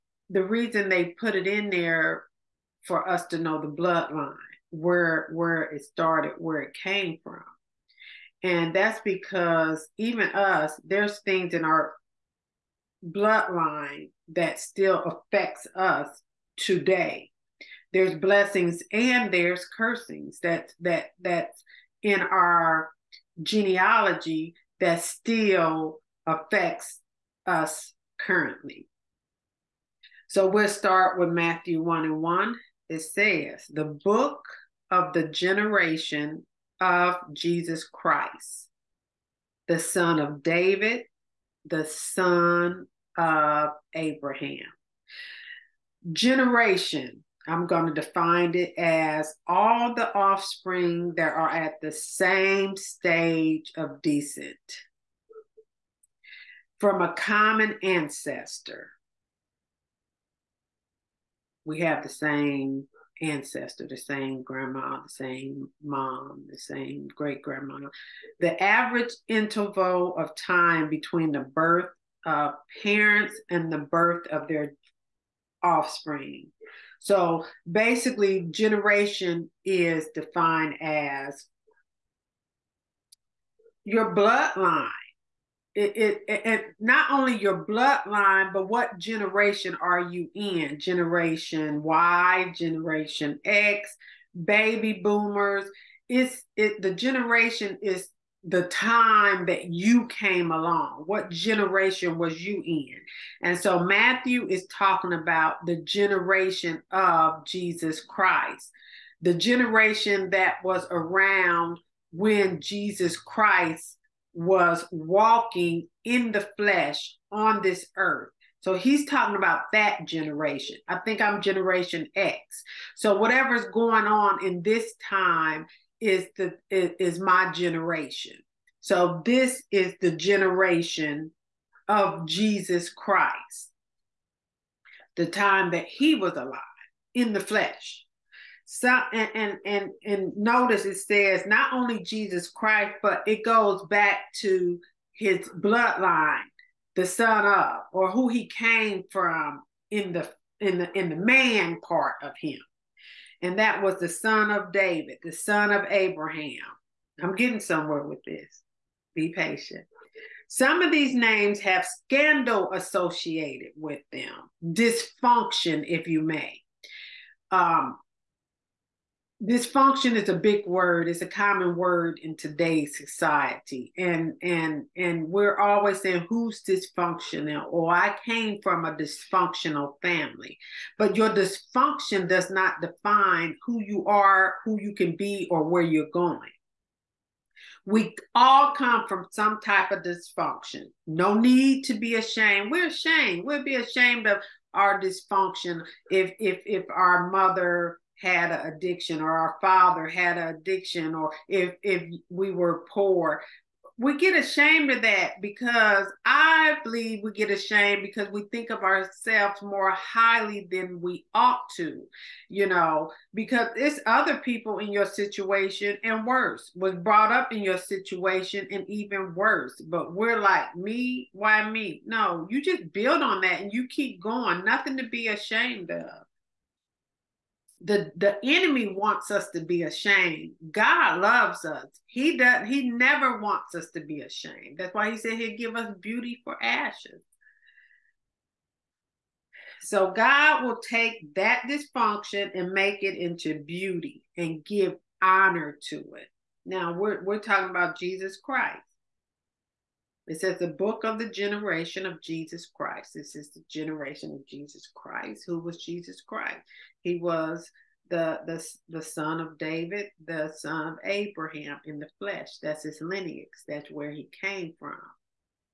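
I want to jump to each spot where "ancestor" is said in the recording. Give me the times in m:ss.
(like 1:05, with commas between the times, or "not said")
0:57, 1:03.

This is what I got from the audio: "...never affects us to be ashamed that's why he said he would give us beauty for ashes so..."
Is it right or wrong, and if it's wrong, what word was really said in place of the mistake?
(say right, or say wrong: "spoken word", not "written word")
wrong: "wants", not "affects".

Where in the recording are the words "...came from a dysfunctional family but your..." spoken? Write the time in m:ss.
2:58.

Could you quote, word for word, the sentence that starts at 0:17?
There's blessings and there's cursings that that that's in our genealogy that still affects us currently.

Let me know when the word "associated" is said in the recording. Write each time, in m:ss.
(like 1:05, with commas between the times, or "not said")
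2:42.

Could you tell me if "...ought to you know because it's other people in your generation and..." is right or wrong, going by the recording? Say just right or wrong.
wrong.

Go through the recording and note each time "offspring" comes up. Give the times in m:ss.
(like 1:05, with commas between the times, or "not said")
0:50, 1:15.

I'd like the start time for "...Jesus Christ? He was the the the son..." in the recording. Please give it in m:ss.
4:15.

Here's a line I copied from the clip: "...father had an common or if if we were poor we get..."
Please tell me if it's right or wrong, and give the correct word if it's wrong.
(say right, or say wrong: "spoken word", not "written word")
wrong: "addiction", not "common".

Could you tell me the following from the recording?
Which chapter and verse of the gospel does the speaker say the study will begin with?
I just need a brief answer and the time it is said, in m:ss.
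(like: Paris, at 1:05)
Matthew 1:1, at 0:31.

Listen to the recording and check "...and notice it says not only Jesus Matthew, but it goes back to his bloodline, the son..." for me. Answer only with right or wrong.
wrong.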